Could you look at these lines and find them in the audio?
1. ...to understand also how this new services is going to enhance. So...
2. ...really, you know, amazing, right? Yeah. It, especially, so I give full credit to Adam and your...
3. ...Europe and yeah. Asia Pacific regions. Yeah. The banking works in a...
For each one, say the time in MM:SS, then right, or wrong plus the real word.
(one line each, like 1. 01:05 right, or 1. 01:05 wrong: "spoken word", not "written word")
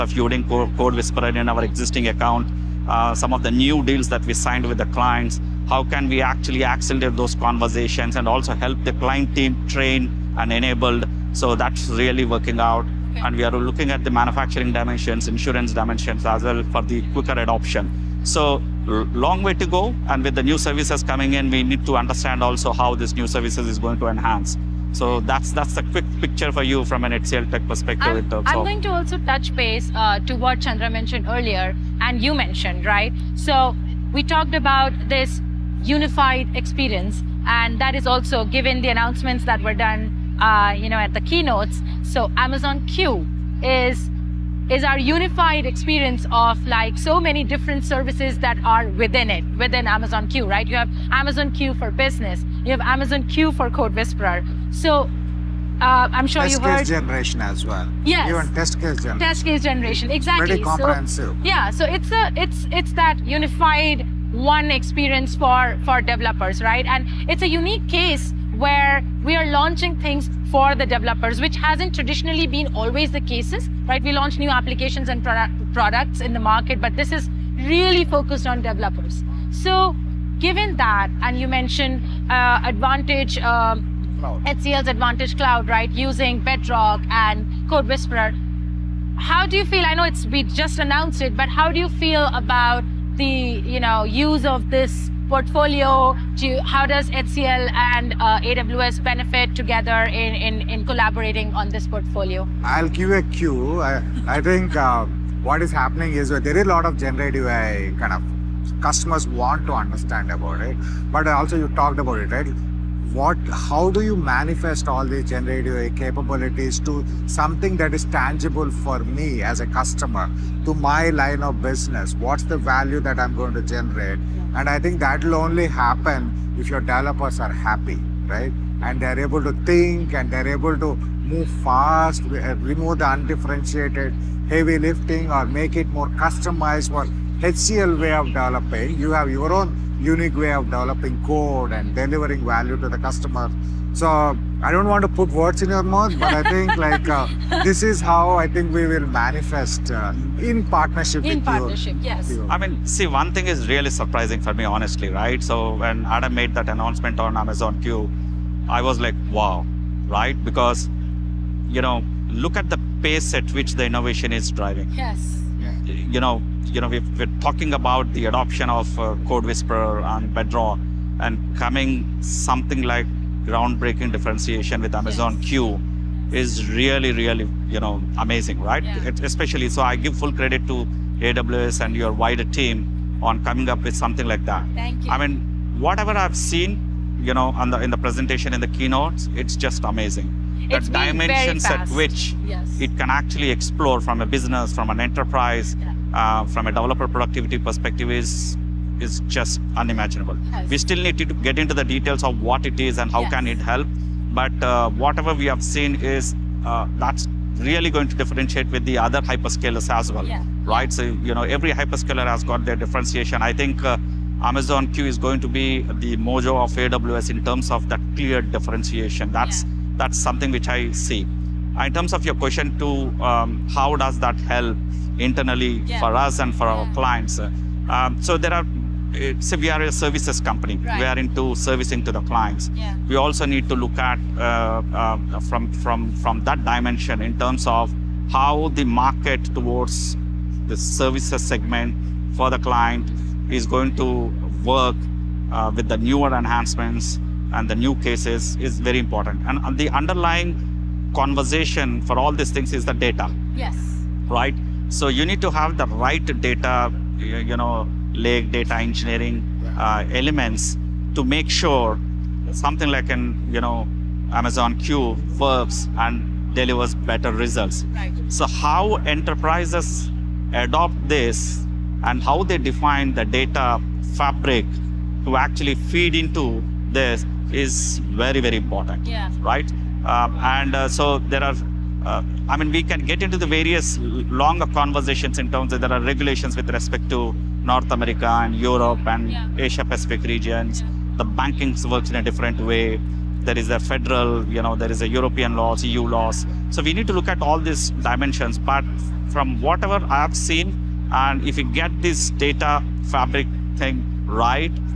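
1. 00:21 right
2. 02:57 wrong: "AWS", not "Adam"
3. 04:48 right.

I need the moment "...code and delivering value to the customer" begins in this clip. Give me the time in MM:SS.
02:21.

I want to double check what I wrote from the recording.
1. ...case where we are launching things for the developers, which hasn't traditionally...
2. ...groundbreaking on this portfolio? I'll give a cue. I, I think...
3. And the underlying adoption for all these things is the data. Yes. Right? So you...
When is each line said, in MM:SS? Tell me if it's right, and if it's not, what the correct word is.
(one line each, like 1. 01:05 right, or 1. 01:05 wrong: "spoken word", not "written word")
1. 01:07 right
2. 01:40 wrong: "collaborating", not "groundbreaking"
3. 04:09 wrong: "conversation", not "adoption".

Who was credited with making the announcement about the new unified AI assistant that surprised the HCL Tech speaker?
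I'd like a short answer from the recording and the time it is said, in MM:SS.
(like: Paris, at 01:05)
Adam, at 02:36.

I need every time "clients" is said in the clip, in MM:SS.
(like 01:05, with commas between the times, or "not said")
00:04, 00:08, 03:46, 03:52, 04:02.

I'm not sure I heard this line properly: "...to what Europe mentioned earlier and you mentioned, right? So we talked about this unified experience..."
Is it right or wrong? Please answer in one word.
wrong.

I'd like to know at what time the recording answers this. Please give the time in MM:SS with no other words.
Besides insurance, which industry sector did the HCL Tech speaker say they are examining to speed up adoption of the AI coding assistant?
00:14.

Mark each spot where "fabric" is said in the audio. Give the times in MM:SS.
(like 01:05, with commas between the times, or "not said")
04:33, 05:03.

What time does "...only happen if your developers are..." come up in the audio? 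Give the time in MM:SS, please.
02:05.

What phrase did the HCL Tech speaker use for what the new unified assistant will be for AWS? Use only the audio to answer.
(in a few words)
the mojo.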